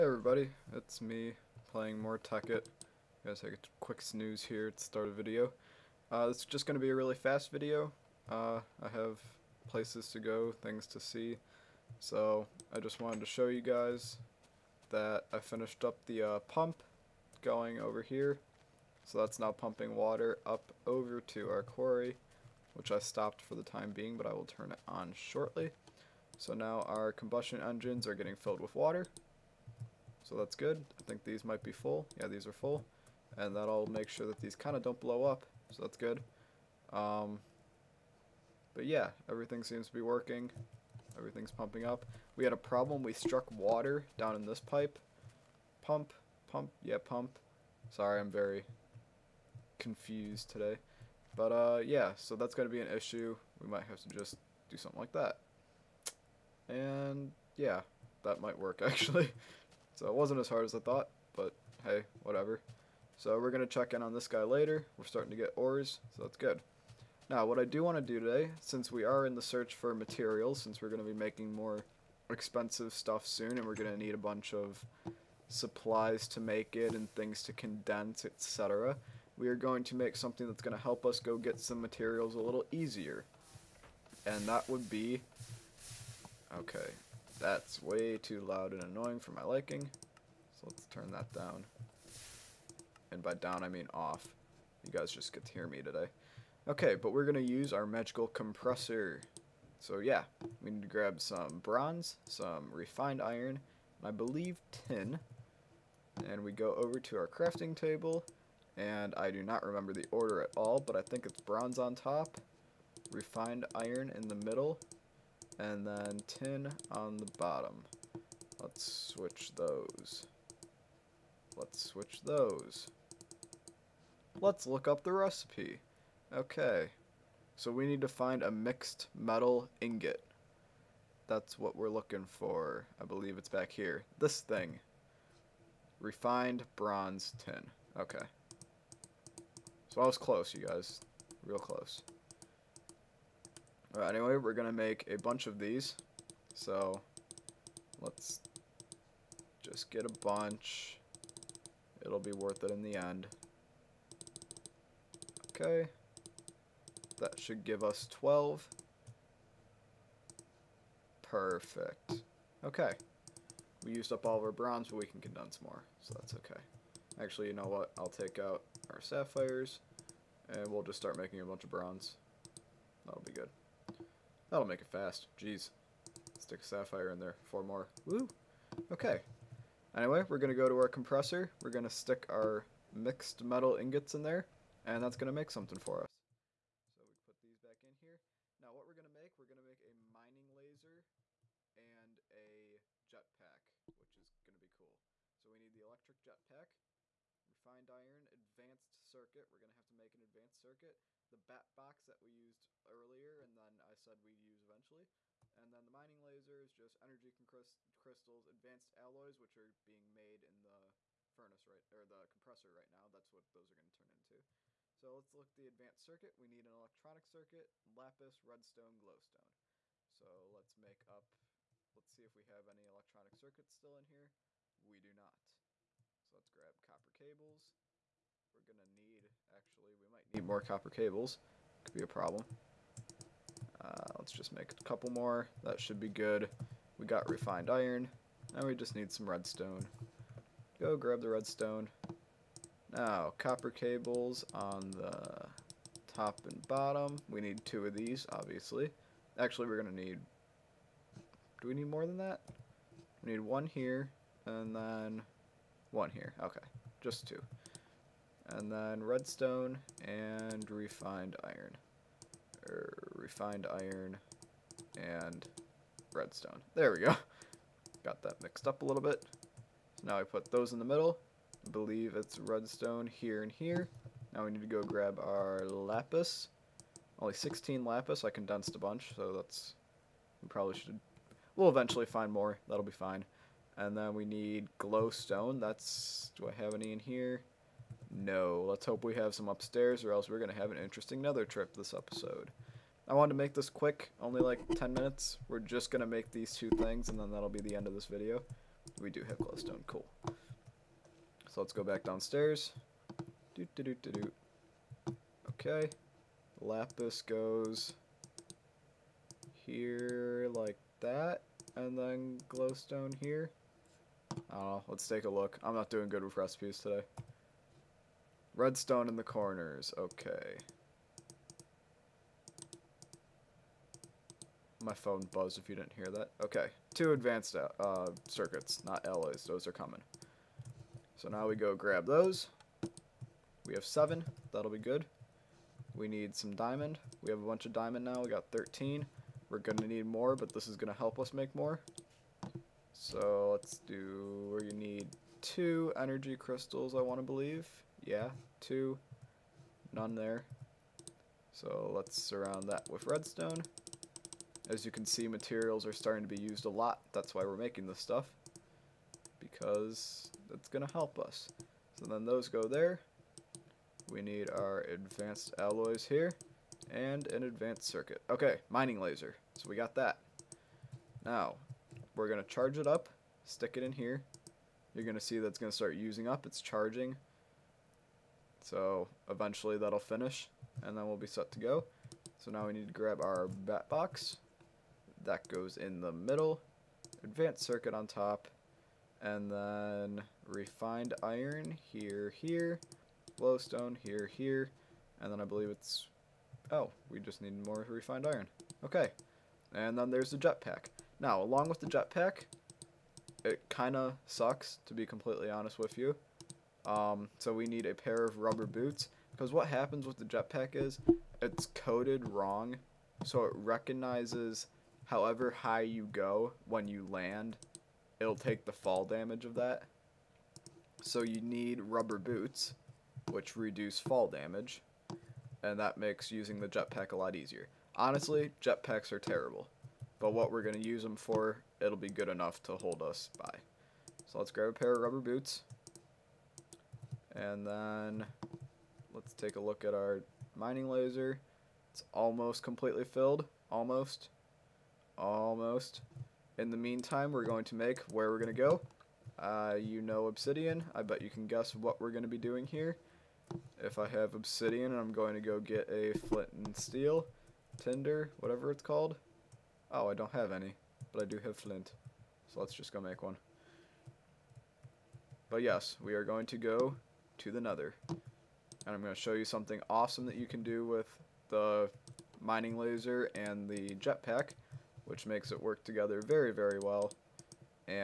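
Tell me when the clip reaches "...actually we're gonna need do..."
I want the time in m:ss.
4:09.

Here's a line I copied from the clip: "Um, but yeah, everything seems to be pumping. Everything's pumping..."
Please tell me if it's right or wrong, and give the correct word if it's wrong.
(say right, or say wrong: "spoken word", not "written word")
wrong: "working", not "pumping".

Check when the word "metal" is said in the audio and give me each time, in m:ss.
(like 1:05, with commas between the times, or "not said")
2:09, 3:03.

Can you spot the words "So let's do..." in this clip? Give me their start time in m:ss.
5:42.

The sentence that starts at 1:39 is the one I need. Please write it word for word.
So yeah, we need to grab some bronze, some refined iron, and I believe tin.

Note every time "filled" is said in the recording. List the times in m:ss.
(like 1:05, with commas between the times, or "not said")
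0:28, 7:23.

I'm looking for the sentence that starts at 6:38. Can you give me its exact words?
Okay, and then there's the jetpack.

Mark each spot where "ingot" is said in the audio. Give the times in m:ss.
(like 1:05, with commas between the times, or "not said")
2:09, 3:03.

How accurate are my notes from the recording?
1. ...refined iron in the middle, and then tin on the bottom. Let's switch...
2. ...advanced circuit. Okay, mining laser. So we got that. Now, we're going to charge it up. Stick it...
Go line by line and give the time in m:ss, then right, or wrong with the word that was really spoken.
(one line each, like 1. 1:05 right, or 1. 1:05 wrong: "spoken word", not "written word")
1. 1:53 right
2. 6:07 right.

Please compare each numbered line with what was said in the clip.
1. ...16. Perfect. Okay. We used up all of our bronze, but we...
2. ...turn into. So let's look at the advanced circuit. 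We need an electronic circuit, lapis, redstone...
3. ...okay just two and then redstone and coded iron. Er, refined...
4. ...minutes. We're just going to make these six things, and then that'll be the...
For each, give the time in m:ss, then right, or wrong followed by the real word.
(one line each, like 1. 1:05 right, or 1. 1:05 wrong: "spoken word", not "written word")
1. 2:38 wrong: "12", not "16"
2. 3:33 right
3. 4:16 wrong: "refined", not "coded"
4. 4:54 wrong: "two", not "six".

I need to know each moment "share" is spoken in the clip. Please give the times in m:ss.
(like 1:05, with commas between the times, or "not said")
not said.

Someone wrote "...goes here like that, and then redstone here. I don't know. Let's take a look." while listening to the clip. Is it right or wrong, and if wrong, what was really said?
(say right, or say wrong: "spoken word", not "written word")
wrong: "glowstone", not "redstone".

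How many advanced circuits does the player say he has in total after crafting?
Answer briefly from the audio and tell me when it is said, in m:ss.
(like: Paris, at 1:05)
7, at 5:33.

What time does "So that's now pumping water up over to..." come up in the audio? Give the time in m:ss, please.
0:19.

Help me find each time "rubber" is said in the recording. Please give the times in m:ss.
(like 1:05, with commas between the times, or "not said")
6:48, 7:01, 7:15.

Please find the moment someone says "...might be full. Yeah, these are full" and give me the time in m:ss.
0:31.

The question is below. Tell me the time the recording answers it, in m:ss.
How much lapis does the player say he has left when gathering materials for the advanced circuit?
4:37.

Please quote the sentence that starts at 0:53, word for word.
We might have to just do something like that.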